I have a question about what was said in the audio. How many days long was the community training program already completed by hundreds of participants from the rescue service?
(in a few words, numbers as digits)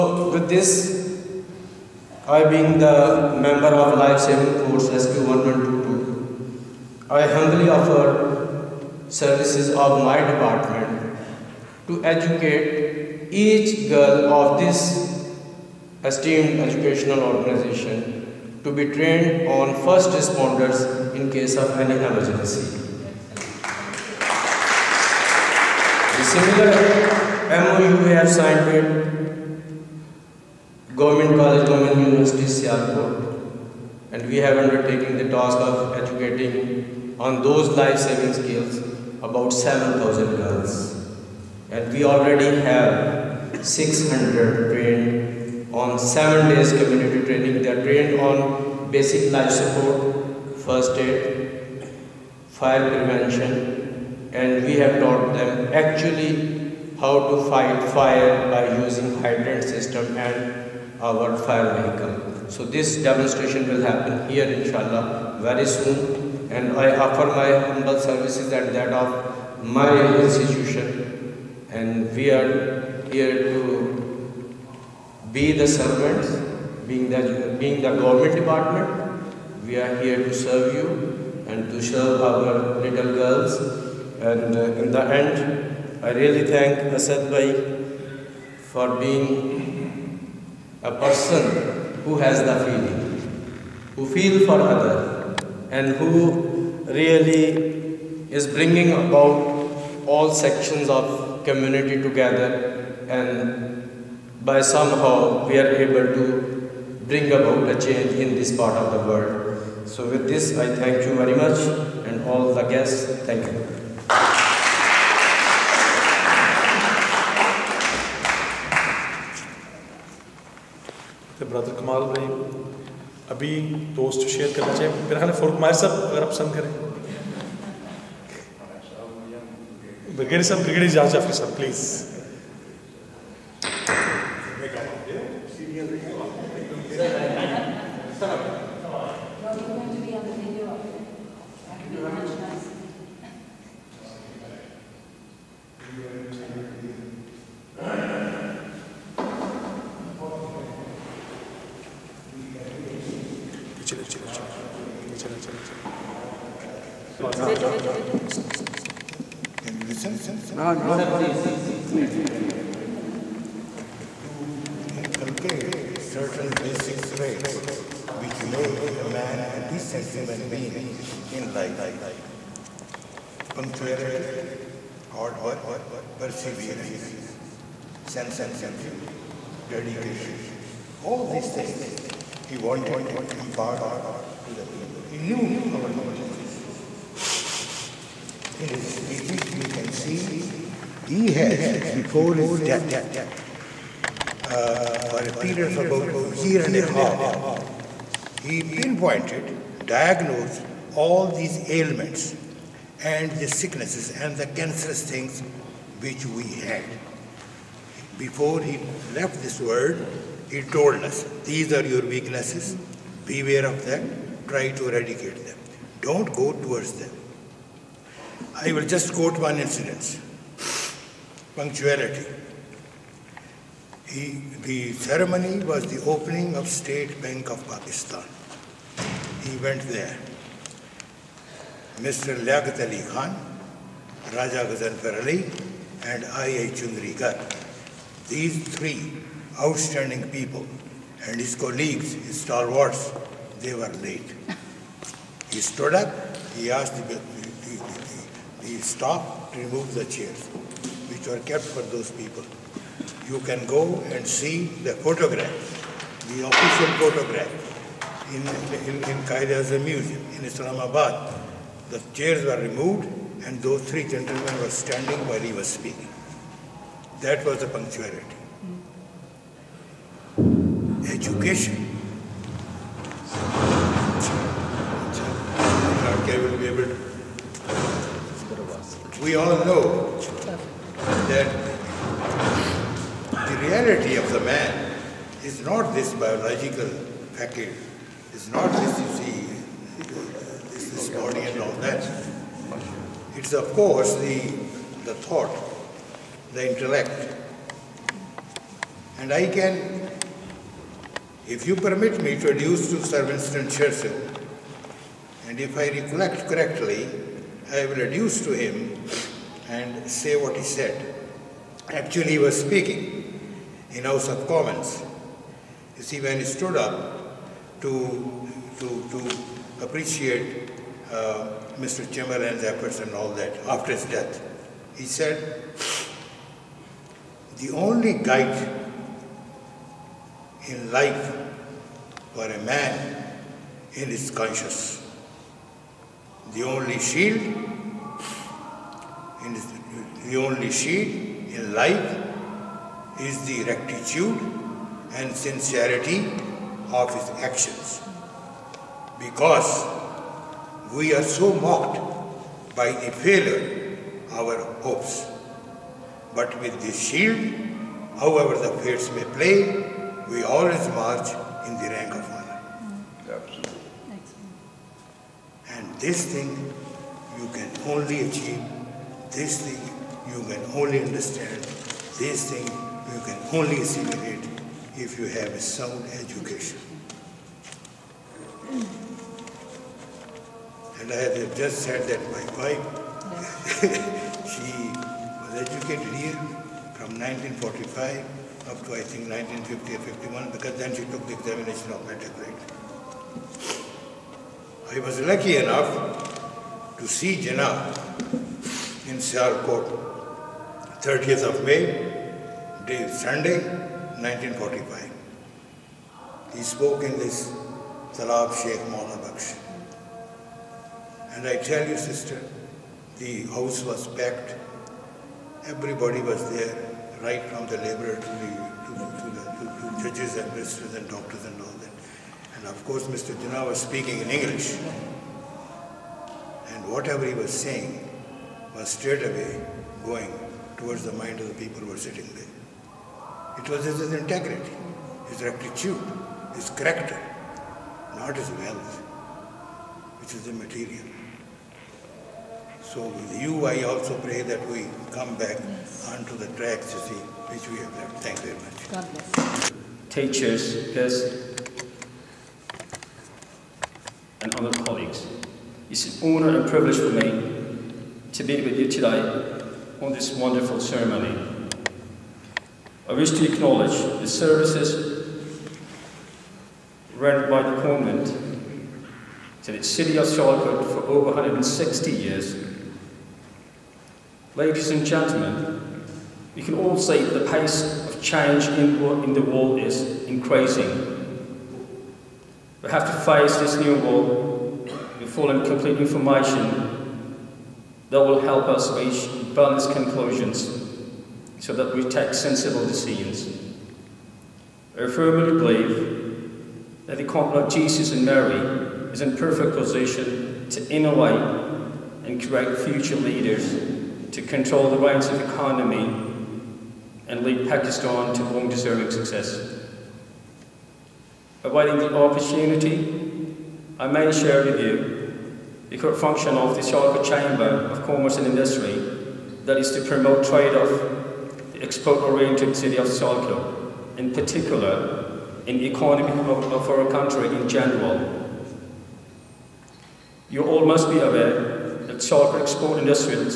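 7.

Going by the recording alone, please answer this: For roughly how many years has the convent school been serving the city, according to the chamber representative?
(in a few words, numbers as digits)
160 years.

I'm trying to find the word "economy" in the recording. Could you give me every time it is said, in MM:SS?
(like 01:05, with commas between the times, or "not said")
08:25, 08:45.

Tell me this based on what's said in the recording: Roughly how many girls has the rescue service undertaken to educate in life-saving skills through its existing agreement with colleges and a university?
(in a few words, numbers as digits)
7,000.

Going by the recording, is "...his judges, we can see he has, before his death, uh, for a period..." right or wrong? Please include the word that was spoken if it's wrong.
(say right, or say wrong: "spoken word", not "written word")
wrong: "speeches", not "judges".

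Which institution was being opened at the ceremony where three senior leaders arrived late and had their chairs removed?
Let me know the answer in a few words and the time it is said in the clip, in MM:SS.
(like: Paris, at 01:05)
State Bank of Pakistan, at 03:46.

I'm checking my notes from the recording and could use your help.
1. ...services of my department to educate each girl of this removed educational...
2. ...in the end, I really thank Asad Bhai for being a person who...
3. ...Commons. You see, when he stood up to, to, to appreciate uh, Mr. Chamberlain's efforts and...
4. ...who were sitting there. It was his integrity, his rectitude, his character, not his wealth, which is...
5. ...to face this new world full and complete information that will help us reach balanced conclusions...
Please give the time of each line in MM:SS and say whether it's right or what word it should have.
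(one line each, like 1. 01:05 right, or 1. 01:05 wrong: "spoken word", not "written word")
1. 00:09 wrong: "esteemed", not "removed"
2. 01:24 right
3. 05:14 right
4. 07:11 right
5. 08:03 right.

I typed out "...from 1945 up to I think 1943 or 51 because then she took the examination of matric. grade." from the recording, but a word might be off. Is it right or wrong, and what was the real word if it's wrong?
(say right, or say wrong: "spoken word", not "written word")
wrong: "1950", not "1943".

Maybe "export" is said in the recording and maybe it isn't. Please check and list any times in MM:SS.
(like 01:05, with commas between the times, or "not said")
08:41, 08:52.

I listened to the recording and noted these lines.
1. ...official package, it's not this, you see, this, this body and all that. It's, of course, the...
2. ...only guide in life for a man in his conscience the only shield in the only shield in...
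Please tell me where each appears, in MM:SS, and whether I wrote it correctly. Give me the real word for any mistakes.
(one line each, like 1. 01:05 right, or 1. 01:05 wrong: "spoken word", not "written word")
1. 04:46 wrong: "biological", not "official"
2. 05:27 right.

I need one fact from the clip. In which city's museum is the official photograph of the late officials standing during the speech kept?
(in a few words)
Islamabad.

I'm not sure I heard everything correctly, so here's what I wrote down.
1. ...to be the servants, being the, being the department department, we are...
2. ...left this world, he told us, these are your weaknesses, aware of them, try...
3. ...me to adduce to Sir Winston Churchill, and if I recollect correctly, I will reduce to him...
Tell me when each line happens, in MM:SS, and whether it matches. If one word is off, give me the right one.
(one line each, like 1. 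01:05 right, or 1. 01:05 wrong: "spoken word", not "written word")
1. 01:13 wrong: "government", not "department"
2. 03:29 wrong: "beware", not "aware"
3. 05:02 right.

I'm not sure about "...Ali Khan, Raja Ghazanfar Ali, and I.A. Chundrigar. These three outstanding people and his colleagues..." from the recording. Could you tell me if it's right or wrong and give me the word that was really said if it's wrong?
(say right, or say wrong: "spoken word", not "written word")
right.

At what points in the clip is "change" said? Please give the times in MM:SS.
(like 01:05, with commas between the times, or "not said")
01:47, 07:58.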